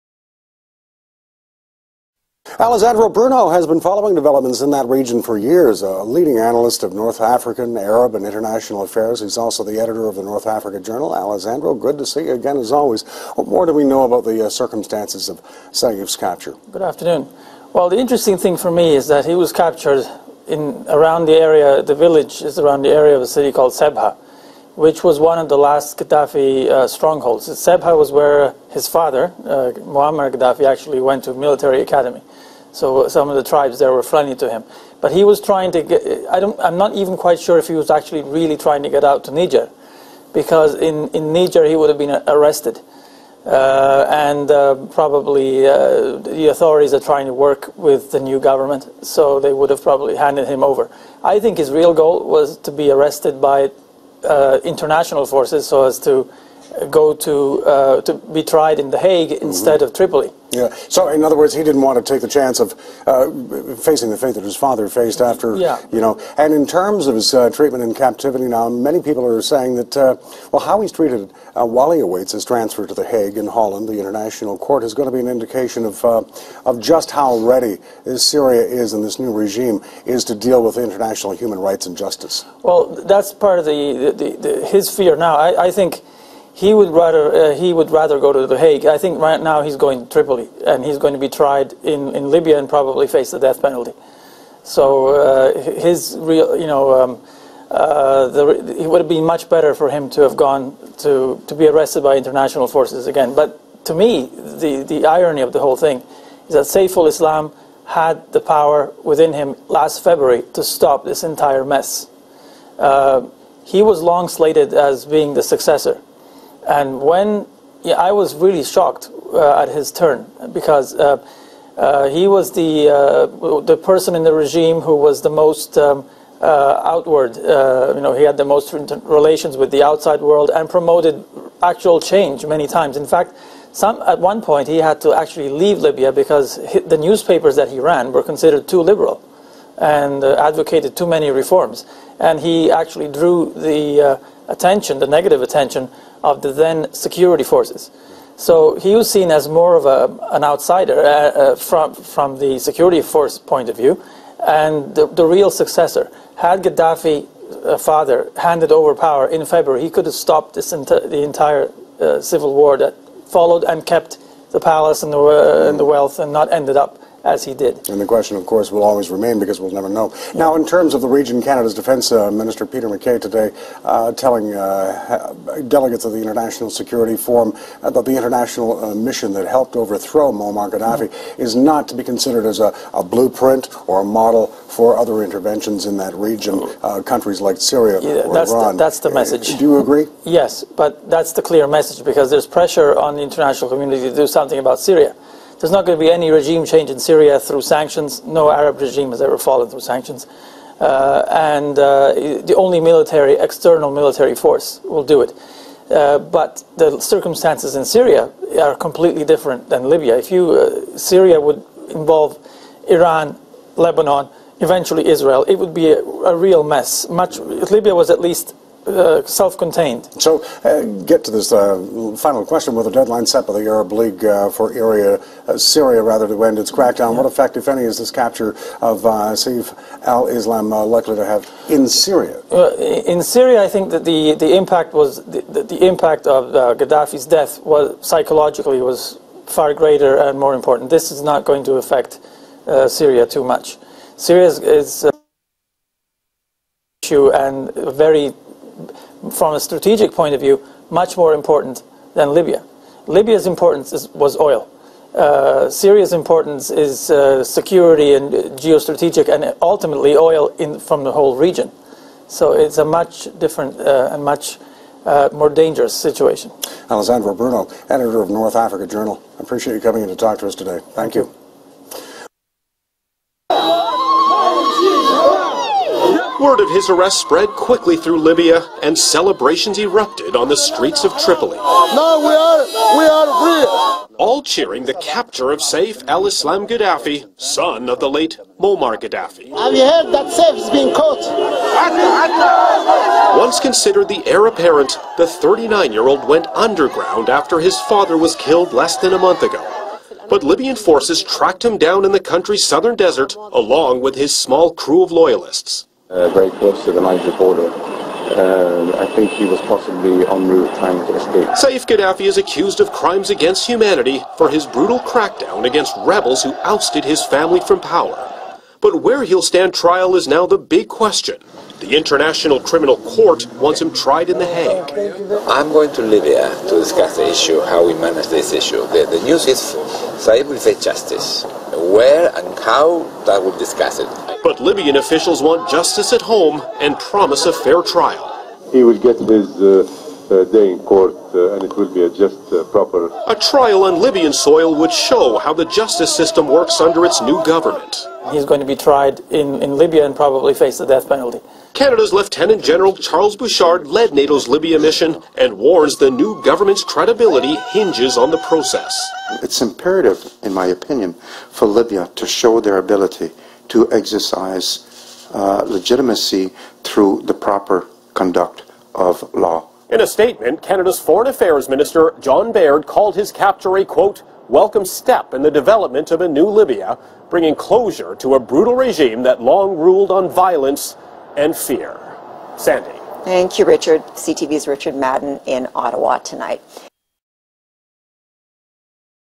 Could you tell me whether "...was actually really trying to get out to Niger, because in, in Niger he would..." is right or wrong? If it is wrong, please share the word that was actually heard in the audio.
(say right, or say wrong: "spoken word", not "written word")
right.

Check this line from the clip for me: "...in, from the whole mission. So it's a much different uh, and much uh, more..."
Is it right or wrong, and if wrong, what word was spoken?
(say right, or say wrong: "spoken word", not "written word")
wrong: "region", not "mission".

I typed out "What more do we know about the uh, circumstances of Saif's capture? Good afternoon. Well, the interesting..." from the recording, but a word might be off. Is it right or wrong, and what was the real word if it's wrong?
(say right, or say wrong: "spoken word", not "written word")
right.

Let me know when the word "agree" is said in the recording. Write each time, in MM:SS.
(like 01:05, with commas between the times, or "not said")
03:09.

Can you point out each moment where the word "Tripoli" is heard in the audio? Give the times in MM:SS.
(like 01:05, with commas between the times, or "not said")
00:59, 01:30, 04:41.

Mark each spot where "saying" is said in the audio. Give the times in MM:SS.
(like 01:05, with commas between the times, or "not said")
01:09.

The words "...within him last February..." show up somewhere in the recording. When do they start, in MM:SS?
01:49.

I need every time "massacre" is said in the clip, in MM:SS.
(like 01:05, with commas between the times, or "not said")
not said.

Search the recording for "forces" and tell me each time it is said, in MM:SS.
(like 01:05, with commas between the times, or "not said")
00:55, 01:42, 02:27, 02:33, 03:24, 05:00.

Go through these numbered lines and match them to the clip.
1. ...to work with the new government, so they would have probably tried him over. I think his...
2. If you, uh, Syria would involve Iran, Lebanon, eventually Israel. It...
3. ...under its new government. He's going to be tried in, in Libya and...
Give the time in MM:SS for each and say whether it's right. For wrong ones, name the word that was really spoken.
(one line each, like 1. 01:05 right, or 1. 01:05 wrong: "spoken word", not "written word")
1. 00:47 wrong: "handed", not "tried"
2. 03:30 right
3. 05:46 right.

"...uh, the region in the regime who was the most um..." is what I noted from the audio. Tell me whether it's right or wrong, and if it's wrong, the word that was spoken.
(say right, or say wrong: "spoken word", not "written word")
wrong: "person", not "region".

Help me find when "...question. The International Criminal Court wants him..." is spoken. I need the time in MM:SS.
05:20.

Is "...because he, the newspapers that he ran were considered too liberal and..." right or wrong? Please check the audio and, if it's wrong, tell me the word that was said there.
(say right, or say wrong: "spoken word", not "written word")
right.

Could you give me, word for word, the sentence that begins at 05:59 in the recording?
It's imperative, in my opinion, for Libya to show their ability to exercise uh, legitimacy through the proper conduct of law.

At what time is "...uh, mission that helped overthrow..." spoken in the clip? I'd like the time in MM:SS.
02:58.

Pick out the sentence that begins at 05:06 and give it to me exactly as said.
Uh, very close to the Niger border.